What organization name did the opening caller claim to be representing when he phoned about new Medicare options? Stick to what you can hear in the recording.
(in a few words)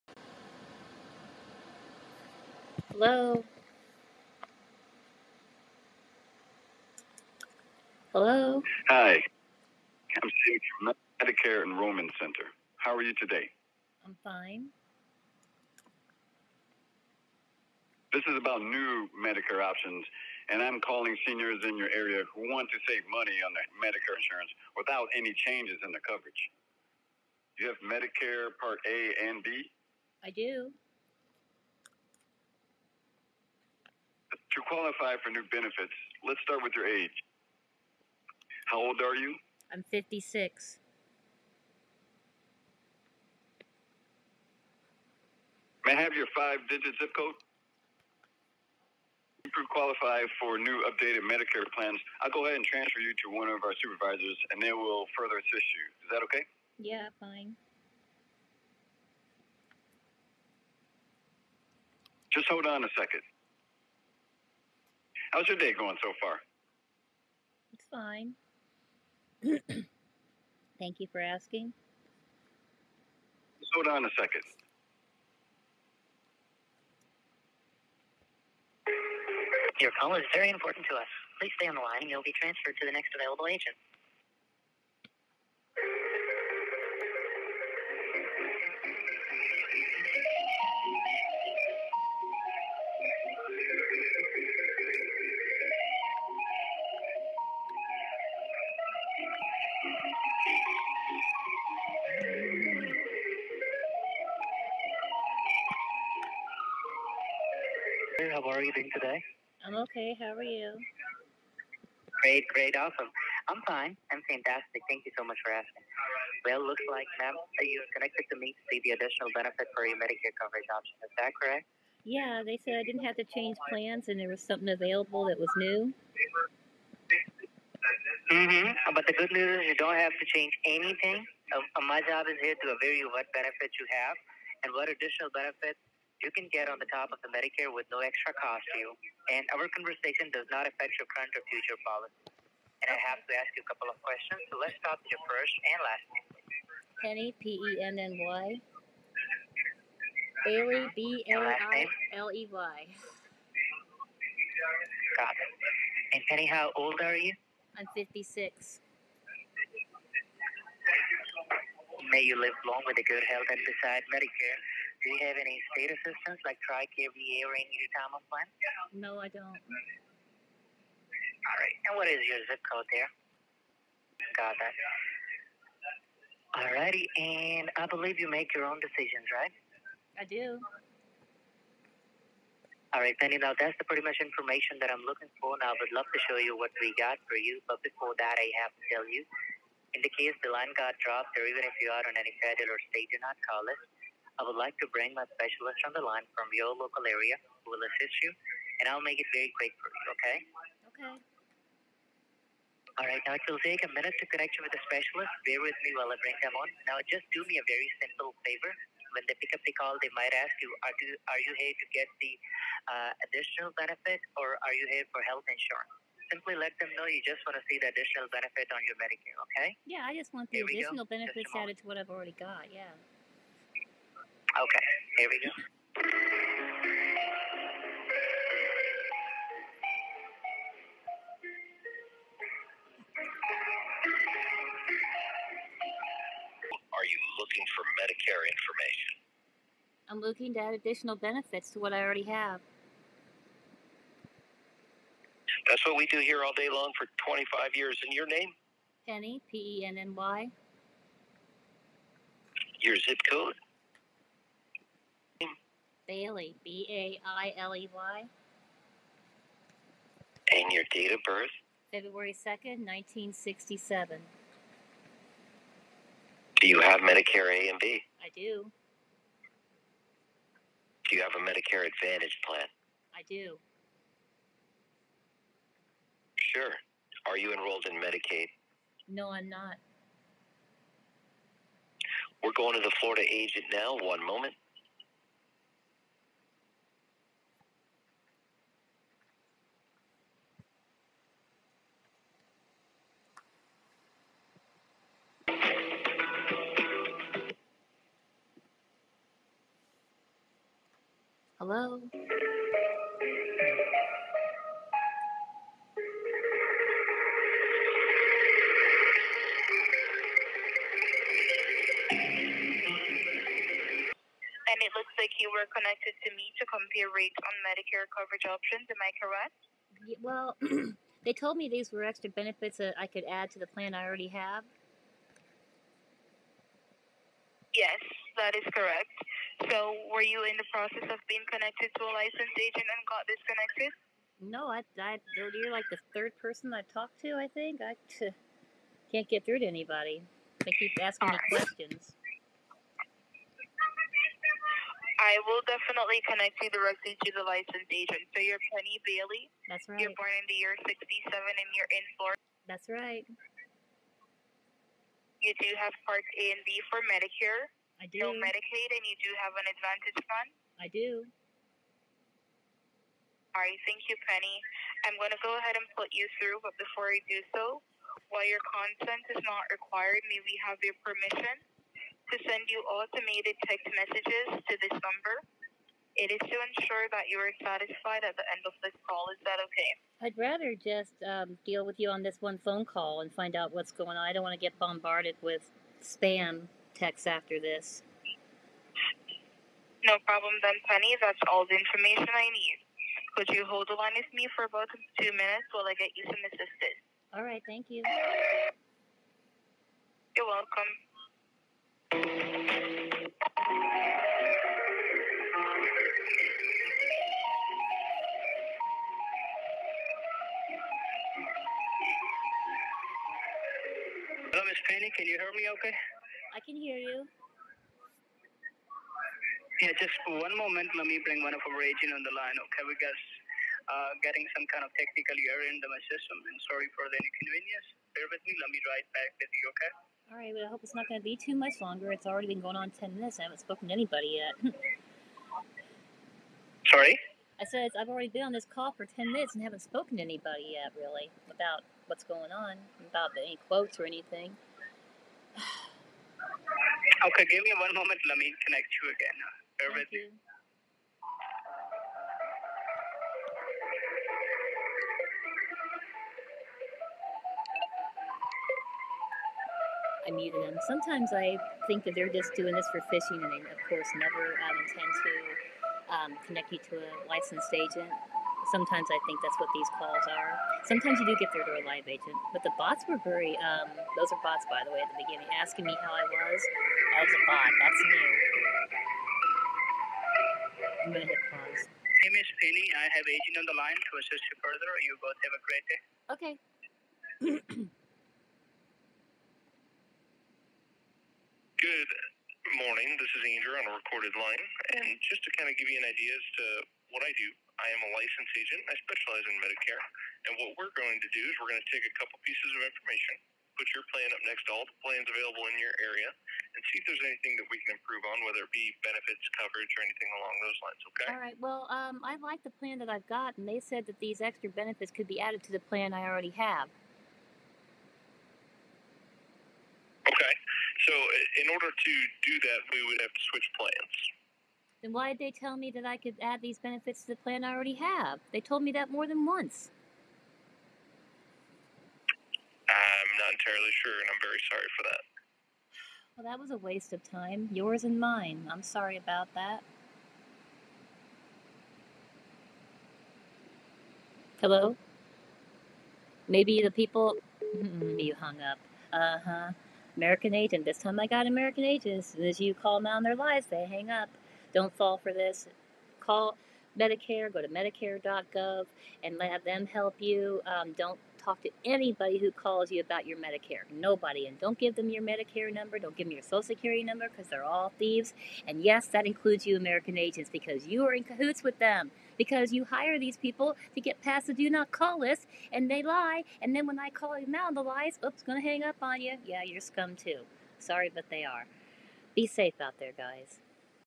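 Medicare Enrollment Center.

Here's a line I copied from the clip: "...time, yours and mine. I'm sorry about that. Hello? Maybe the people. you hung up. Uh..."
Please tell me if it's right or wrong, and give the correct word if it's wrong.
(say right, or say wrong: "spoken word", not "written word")
right.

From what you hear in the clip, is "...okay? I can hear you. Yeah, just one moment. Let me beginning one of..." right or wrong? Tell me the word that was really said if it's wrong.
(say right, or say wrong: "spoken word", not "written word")
wrong: "bring", not "beginning".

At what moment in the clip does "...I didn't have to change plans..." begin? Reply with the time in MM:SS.
02:02.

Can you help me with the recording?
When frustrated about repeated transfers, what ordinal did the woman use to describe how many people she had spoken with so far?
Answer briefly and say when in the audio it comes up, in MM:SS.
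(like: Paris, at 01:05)
third, at 05:36.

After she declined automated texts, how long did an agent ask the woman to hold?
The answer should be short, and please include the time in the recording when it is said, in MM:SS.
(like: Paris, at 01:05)
2 minutes, at 06:35.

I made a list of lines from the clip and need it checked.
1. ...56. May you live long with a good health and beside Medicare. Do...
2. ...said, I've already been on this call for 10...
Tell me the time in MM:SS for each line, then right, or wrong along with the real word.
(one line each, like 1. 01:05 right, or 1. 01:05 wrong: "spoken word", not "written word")
1. 02:37 right
2. 07:17 right.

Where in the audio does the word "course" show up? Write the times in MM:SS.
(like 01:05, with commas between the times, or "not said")
07:43.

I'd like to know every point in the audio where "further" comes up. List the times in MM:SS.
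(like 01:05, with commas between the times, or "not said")
00:55, 08:04.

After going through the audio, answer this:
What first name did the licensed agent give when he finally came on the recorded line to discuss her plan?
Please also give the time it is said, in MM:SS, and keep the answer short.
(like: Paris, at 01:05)
Andrew, at 08:13.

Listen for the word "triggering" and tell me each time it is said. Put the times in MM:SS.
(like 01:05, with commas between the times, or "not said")
not said.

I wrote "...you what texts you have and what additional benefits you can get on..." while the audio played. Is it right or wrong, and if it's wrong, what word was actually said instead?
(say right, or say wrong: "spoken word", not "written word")
wrong: "benefits", not "texts".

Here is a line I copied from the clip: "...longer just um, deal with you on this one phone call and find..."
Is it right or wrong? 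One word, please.
wrong.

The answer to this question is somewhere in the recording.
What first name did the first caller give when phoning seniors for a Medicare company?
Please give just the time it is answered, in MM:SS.
00:10.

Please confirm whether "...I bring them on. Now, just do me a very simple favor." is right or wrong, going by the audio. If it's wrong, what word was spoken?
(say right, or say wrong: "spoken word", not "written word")
right.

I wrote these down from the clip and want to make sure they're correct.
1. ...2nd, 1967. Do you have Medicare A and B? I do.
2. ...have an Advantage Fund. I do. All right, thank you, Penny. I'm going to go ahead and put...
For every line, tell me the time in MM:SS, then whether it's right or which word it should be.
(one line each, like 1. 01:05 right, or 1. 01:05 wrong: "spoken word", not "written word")
1. 04:22 right
2. 05:59 right.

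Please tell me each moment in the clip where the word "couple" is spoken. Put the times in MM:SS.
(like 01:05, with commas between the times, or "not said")
02:23, 08:22.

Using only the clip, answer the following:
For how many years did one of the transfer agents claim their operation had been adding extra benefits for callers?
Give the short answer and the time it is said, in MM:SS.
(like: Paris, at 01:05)
25 years, at 04:07.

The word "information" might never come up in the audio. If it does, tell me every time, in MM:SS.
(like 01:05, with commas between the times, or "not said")
03:04, 03:58, 06:31, 08:22.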